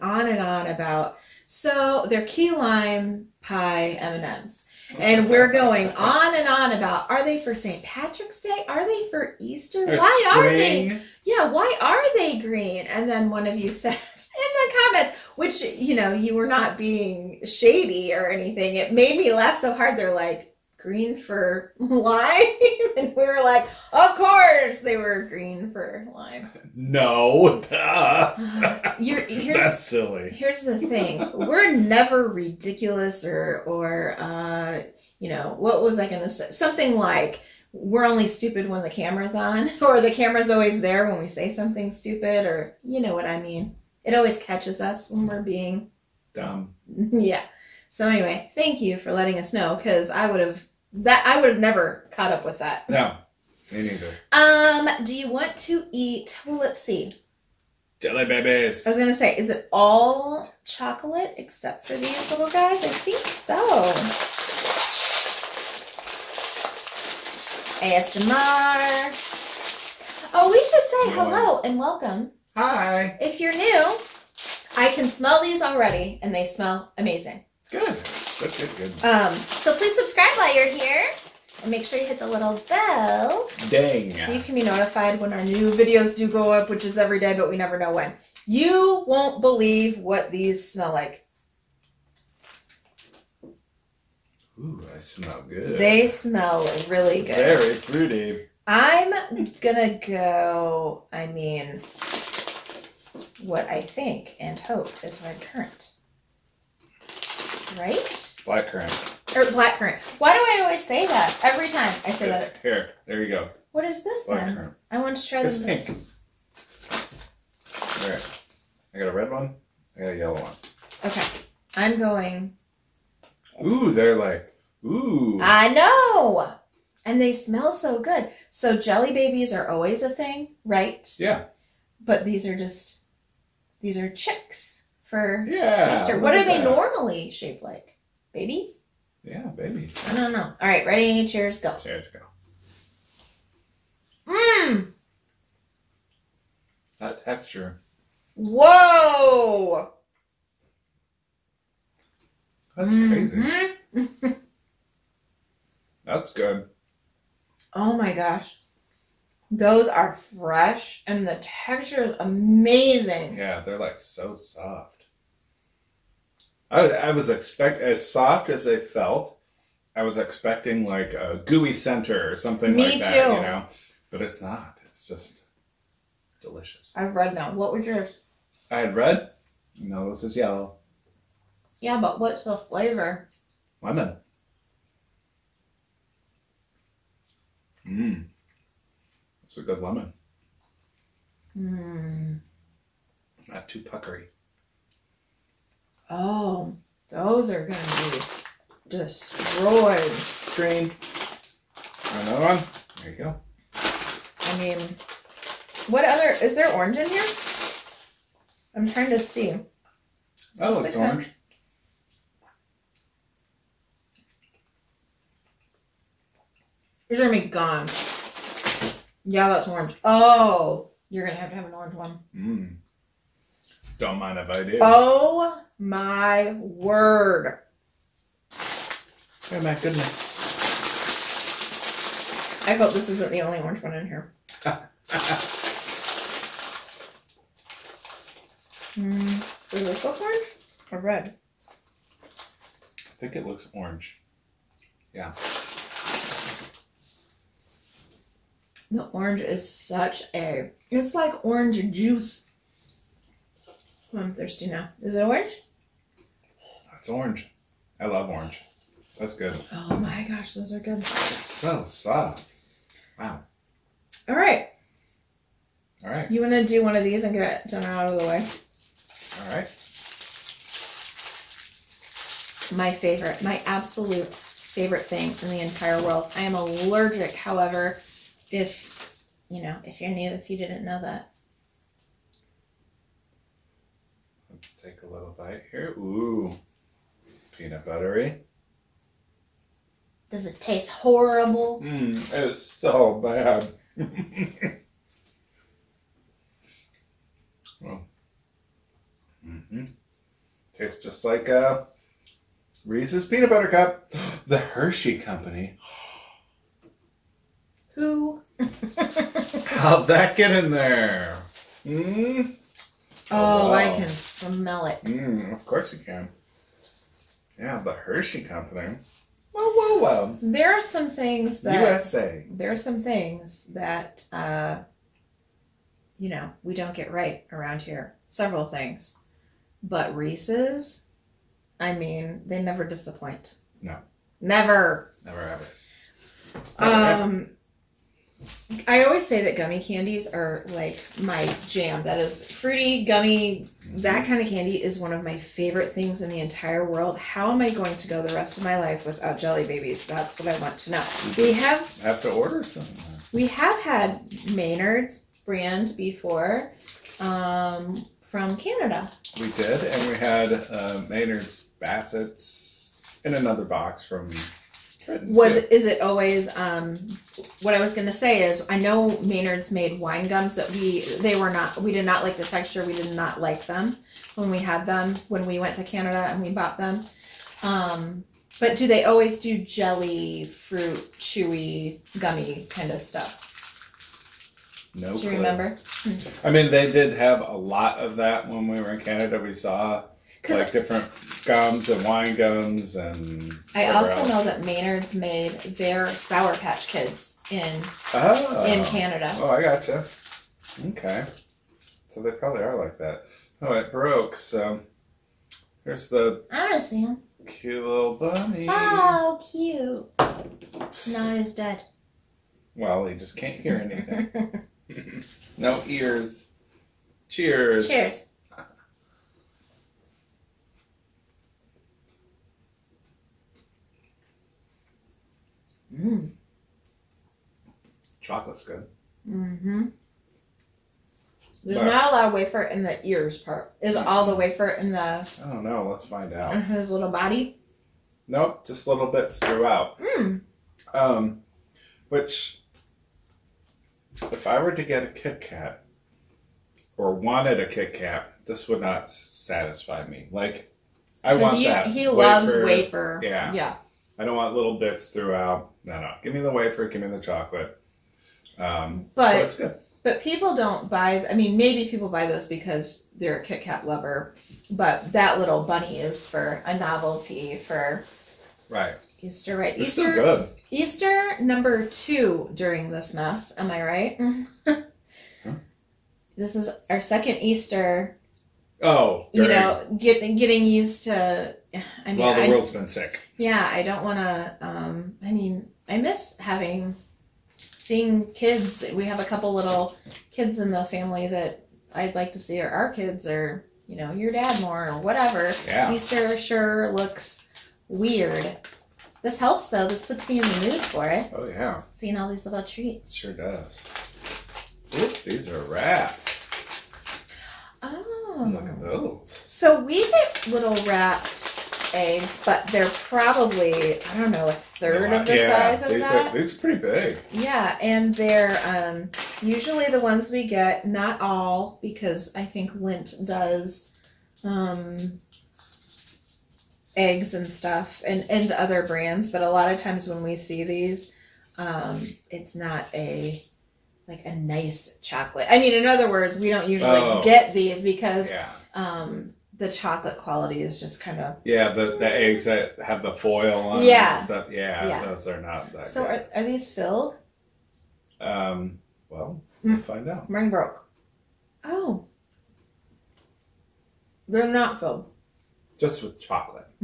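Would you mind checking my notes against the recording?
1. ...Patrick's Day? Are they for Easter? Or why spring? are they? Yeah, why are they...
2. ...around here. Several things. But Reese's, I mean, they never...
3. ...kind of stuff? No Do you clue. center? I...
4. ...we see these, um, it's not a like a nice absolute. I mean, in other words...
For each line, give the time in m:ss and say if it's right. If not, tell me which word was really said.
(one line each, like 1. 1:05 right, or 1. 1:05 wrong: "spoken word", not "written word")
1. 0:07 right
2. 5:27 right
3. 6:22 wrong: "remember", not "center"
4. 8:50 wrong: "chocolate", not "absolute".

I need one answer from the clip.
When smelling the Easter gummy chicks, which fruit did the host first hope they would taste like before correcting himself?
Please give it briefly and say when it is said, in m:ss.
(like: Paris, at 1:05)
Red currant, at 1:45.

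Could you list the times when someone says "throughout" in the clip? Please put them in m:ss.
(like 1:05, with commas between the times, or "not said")
7:19, 7:35.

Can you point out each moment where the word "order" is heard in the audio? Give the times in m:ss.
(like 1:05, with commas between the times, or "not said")
5:52.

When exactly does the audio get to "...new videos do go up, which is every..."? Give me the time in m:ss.
1:25.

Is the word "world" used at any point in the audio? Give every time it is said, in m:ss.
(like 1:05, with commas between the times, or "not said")
4:36, 5:46, 8:02.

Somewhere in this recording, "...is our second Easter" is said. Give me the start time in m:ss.
7:56.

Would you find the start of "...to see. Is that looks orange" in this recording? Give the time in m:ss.
3:29.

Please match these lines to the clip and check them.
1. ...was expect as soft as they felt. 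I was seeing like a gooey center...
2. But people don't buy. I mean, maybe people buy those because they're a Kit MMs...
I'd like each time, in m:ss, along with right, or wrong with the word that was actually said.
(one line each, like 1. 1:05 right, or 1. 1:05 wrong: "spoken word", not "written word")
1. 2:47 wrong: "expecting", not "seeing"
2. 7:40 wrong: "Kat", not "MMs".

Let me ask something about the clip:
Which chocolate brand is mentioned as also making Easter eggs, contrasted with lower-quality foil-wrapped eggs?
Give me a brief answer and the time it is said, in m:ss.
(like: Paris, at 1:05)
Lindt, at 8:42.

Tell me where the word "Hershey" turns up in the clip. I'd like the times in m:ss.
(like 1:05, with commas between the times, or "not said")
5:04, 5:17.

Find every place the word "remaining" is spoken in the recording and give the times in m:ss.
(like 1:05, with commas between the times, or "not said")
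not said.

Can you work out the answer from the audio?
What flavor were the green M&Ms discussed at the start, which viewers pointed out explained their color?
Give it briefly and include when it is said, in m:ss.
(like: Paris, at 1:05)
Key lime pie, at 0:02.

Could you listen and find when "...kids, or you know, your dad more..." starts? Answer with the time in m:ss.
8:12.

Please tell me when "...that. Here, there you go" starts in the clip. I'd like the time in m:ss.
1:52.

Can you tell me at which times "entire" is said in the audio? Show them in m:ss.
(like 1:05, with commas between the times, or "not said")
4:35, 5:46.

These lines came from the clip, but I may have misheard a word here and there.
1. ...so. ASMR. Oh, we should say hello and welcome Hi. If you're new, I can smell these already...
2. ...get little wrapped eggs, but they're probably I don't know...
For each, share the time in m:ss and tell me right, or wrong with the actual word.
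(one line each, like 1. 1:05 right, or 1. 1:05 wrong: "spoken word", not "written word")
1. 1:03 right
2. 8:30 right.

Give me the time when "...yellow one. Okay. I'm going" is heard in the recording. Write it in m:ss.
2:00.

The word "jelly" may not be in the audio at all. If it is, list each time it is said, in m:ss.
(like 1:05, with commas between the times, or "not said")
0:57, 2:08, 5:49, 6:19.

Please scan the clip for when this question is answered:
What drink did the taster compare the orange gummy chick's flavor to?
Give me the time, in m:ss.
4:11.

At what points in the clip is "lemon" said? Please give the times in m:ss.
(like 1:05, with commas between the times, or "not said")
3:03, 3:09.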